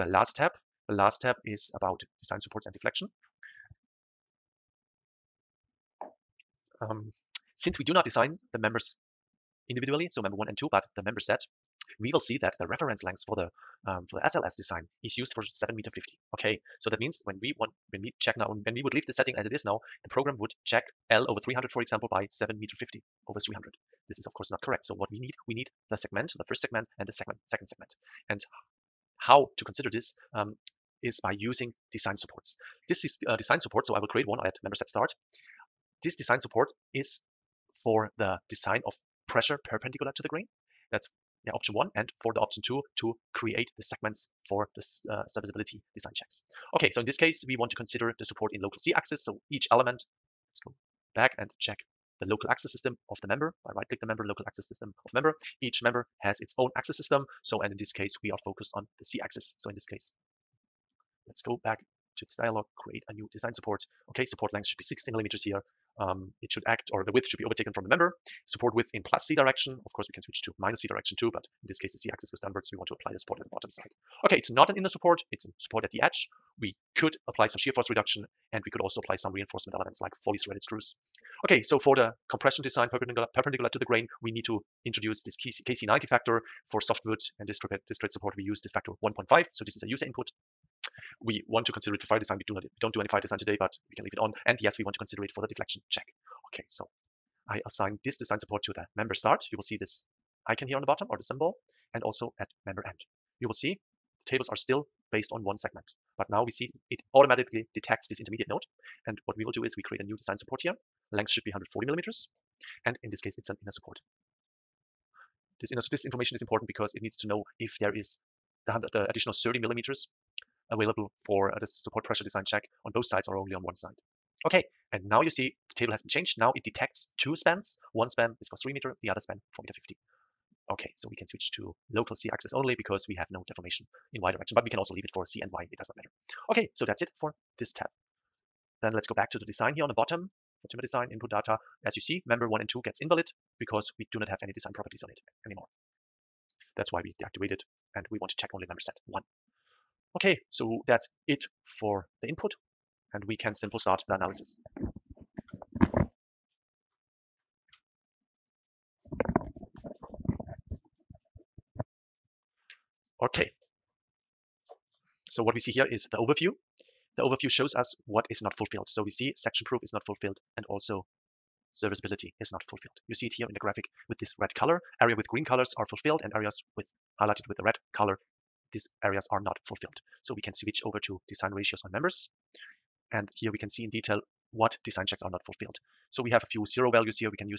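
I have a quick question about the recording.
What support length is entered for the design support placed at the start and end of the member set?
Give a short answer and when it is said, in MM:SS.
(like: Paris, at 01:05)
60 millimeters, at 01:04.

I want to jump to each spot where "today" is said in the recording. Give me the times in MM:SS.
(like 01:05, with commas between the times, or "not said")
01:33.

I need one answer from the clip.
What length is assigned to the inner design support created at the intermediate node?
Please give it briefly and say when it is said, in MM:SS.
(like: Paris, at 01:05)
140 millimeters, at 01:51.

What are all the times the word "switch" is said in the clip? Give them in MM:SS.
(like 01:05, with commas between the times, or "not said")
01:10, 02:11, 03:00.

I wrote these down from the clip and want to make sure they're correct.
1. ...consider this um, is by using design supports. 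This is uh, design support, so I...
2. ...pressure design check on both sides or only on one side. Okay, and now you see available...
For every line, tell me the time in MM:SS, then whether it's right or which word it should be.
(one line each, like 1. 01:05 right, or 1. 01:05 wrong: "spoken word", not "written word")
1. 00:29 right
2. 02:02 wrong: "table", not "available".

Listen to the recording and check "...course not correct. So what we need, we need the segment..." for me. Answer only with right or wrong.
right.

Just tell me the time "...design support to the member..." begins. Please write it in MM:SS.
01:38.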